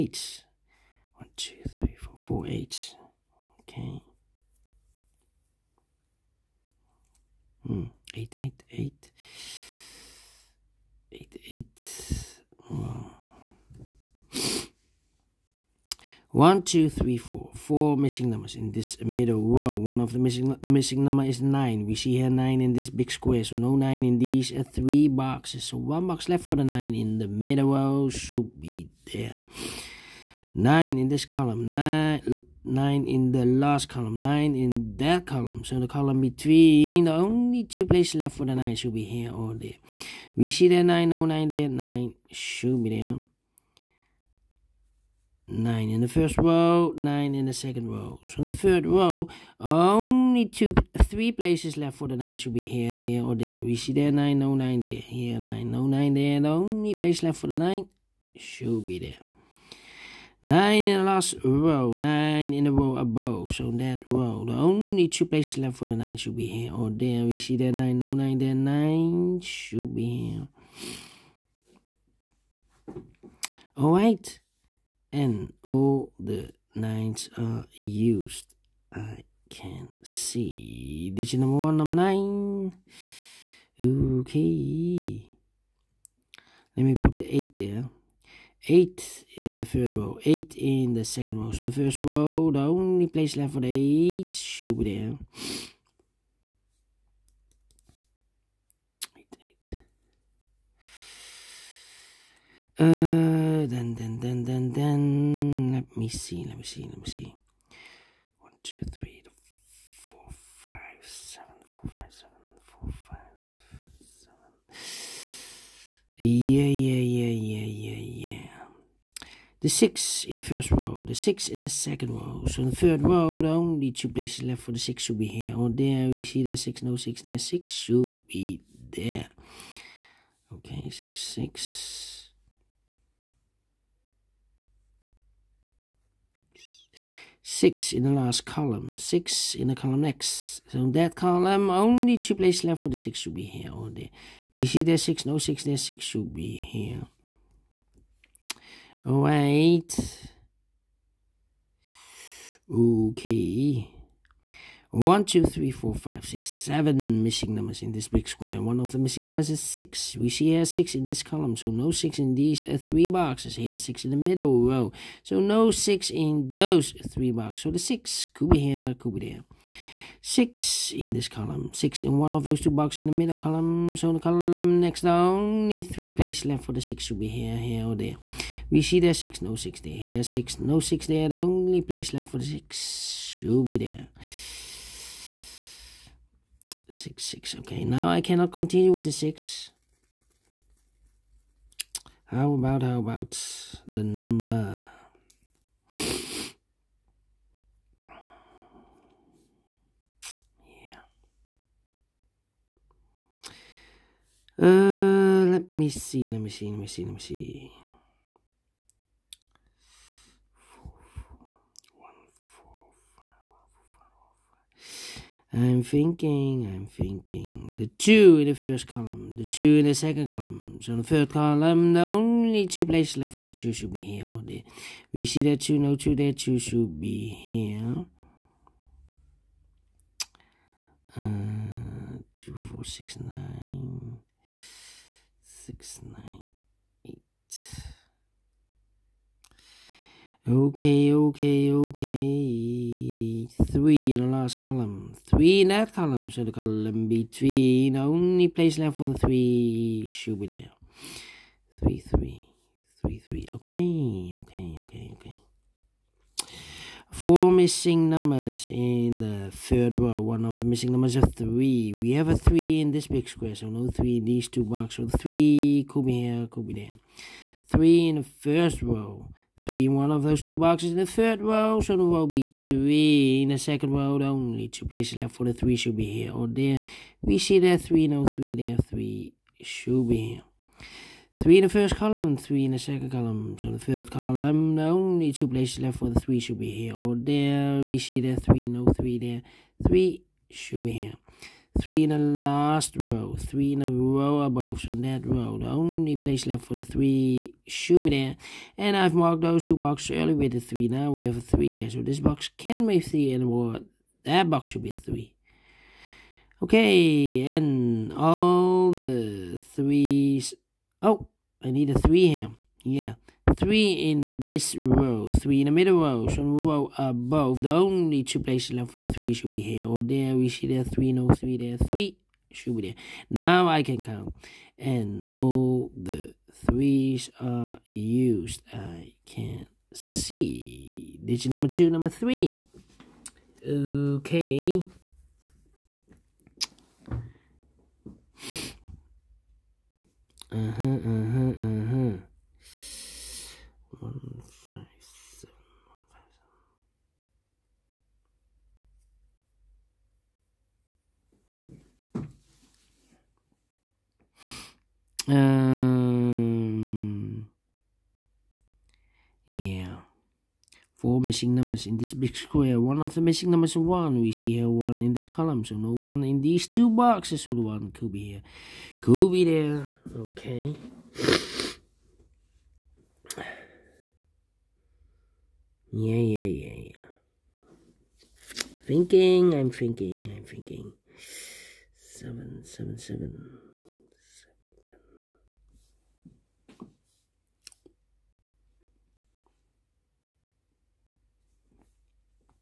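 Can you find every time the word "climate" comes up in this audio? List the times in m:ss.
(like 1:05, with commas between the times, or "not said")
not said.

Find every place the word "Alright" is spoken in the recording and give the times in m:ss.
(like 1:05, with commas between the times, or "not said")
1:13, 2:29.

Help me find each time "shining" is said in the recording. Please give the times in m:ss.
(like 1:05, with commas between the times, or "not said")
not said.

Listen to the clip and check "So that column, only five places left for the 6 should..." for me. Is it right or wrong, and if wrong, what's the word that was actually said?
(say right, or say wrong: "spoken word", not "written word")
wrong: "two", not "five".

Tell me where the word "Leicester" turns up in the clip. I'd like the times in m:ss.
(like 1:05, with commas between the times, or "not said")
not said.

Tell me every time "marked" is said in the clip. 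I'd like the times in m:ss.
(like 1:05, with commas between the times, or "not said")
4:59.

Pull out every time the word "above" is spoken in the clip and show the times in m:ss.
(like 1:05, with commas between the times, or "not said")
1:02, 4:54, 5:16.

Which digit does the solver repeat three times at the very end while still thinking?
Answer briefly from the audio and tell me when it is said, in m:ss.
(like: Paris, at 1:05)
7, at 6:21.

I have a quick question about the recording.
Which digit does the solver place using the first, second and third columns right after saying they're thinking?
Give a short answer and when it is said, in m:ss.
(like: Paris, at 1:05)
2, at 3:37.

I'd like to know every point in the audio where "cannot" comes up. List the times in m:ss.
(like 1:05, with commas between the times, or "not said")
3:08.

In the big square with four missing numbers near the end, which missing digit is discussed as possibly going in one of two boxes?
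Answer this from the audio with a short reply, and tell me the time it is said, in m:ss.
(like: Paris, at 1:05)
1, at 6:02.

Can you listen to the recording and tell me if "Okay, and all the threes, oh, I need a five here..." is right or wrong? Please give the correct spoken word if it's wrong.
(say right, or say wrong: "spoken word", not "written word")
wrong: "three", not "five".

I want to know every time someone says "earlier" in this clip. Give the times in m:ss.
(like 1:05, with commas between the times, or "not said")
5:00.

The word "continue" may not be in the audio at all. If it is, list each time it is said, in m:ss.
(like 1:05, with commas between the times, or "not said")
3:08.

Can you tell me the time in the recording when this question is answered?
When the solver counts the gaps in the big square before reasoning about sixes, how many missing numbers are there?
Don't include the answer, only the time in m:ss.
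2:34.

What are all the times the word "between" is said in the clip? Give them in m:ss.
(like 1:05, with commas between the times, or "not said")
0:36, 4:07.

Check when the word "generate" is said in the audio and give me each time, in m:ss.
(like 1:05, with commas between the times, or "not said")
not said.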